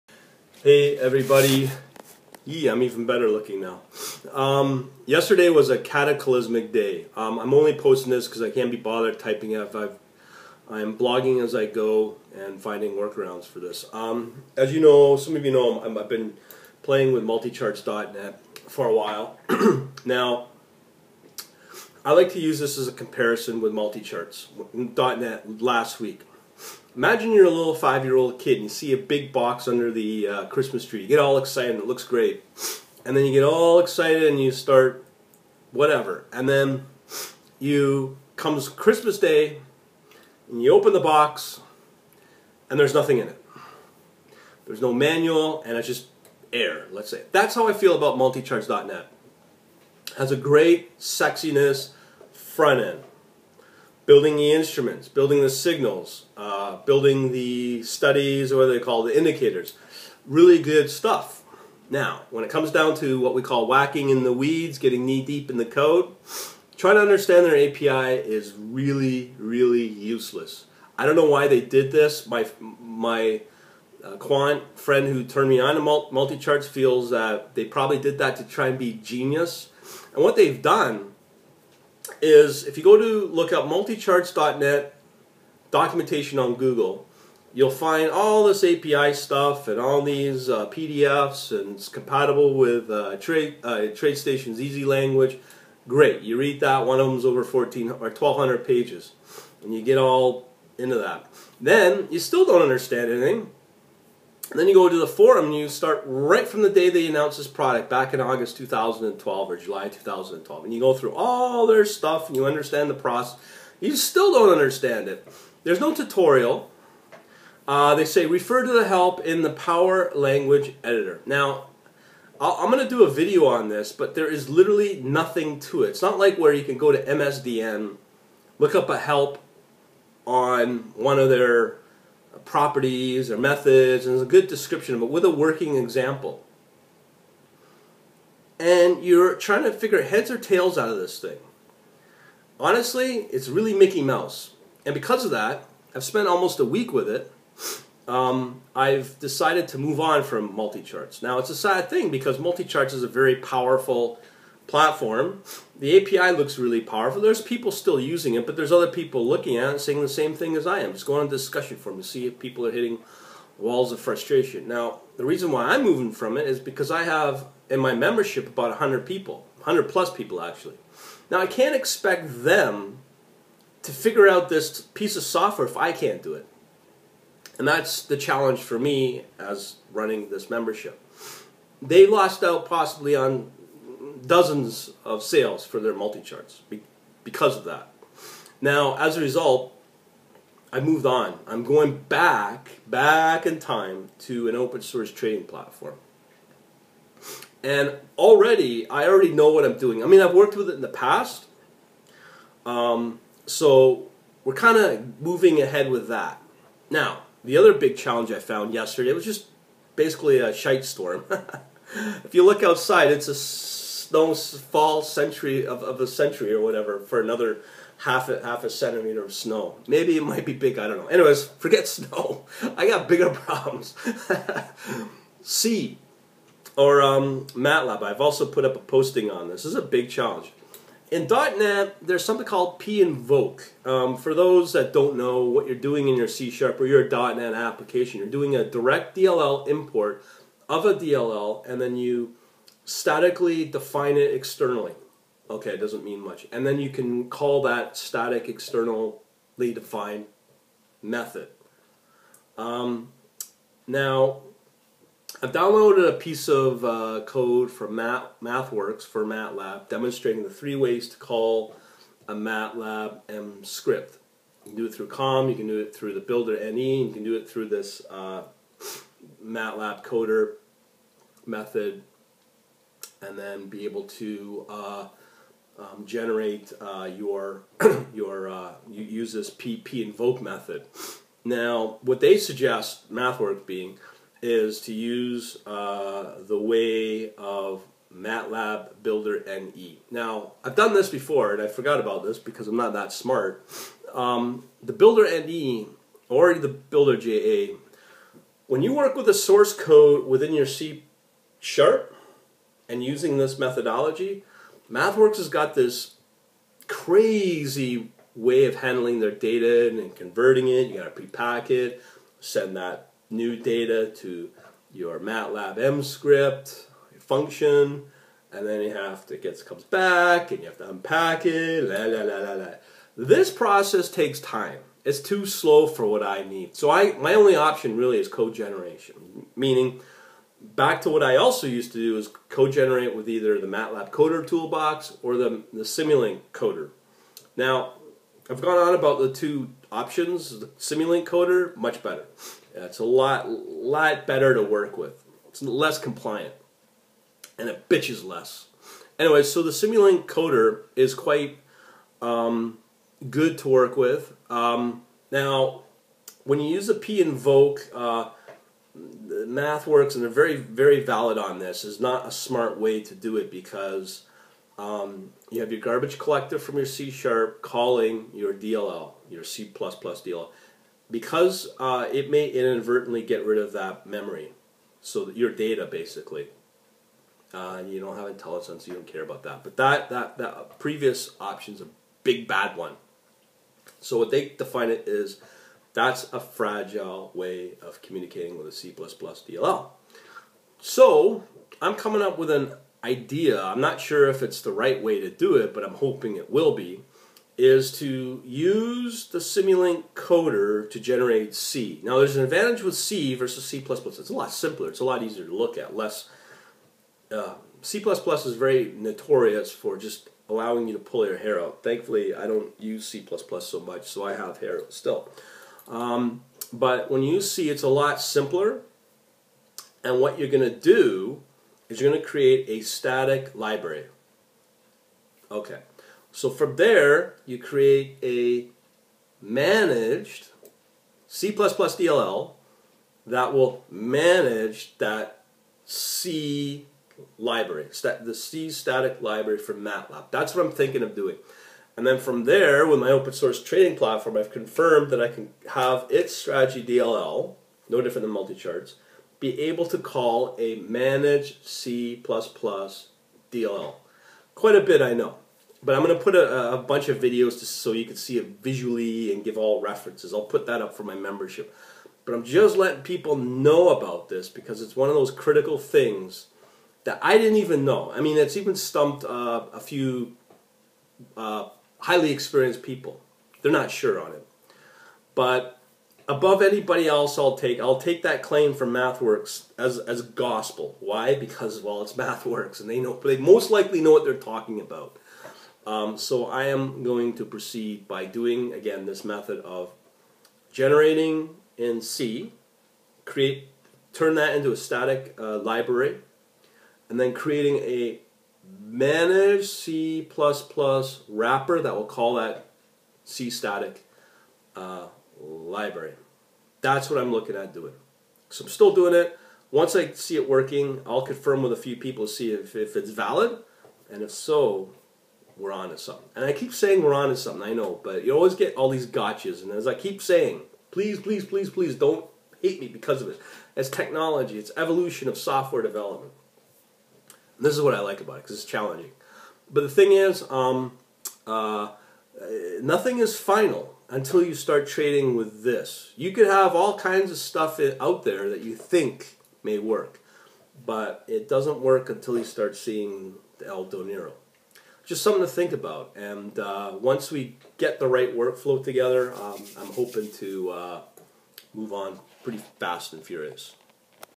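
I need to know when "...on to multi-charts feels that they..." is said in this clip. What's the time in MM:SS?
01:15.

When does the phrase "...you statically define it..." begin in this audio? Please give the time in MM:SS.
04:01.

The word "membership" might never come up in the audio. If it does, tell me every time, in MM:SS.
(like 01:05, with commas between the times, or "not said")
02:47, 03:00, 07:41.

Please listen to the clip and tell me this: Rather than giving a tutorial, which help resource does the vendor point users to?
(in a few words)
PowerLanguage Editor.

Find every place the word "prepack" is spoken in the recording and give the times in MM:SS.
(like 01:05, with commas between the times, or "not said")
05:11.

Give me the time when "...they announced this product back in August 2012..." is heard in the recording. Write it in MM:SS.
01:46.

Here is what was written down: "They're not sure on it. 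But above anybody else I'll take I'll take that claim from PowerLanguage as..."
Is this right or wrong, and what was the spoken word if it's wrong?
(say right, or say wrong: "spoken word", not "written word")
wrong: "MathWorks", not "PowerLanguage".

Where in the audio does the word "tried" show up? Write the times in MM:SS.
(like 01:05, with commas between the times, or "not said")
not said.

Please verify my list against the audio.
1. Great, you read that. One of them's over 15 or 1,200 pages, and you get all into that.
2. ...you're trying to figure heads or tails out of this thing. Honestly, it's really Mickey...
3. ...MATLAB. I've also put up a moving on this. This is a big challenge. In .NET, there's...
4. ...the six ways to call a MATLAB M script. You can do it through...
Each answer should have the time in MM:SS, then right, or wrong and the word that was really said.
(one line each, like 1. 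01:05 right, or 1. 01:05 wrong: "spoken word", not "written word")
1. 01:35 wrong: "14", not "15"
2. 02:19 right
3. 03:47 wrong: "posting", not "moving"
4. 04:20 wrong: "three", not "six".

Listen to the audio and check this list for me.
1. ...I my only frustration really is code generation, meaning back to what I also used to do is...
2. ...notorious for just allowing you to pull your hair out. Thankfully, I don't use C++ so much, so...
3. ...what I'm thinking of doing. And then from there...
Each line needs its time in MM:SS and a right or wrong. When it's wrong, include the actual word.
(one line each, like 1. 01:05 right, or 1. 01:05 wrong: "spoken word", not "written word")
1. 05:26 wrong: "option", not "frustration"
2. 06:48 right
3. 07:20 right.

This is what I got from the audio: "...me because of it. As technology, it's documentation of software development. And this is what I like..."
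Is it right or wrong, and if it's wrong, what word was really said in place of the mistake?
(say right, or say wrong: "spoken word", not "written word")
wrong: "evolution", not "documentation".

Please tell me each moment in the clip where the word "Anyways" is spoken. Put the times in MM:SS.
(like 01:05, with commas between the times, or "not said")
03:41, 05:49.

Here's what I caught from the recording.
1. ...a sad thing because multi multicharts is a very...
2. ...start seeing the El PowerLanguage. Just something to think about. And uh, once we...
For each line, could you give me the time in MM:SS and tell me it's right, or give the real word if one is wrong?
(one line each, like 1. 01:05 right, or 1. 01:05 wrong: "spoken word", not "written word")
1. 02:31 wrong: "charts", not "multicharts"
2. 09:02 wrong: "Donero", not "PowerLanguage".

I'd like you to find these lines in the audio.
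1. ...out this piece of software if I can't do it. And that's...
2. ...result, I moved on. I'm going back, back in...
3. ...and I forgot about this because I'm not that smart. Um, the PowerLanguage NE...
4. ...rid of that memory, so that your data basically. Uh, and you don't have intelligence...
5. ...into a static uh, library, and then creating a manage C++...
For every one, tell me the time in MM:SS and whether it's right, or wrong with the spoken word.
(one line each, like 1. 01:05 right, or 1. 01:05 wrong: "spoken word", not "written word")
1. 02:54 right
2. 03:09 right
3. 04:51 wrong: "Builder", not "PowerLanguage"
4. 06:13 right
5. 08:14 right.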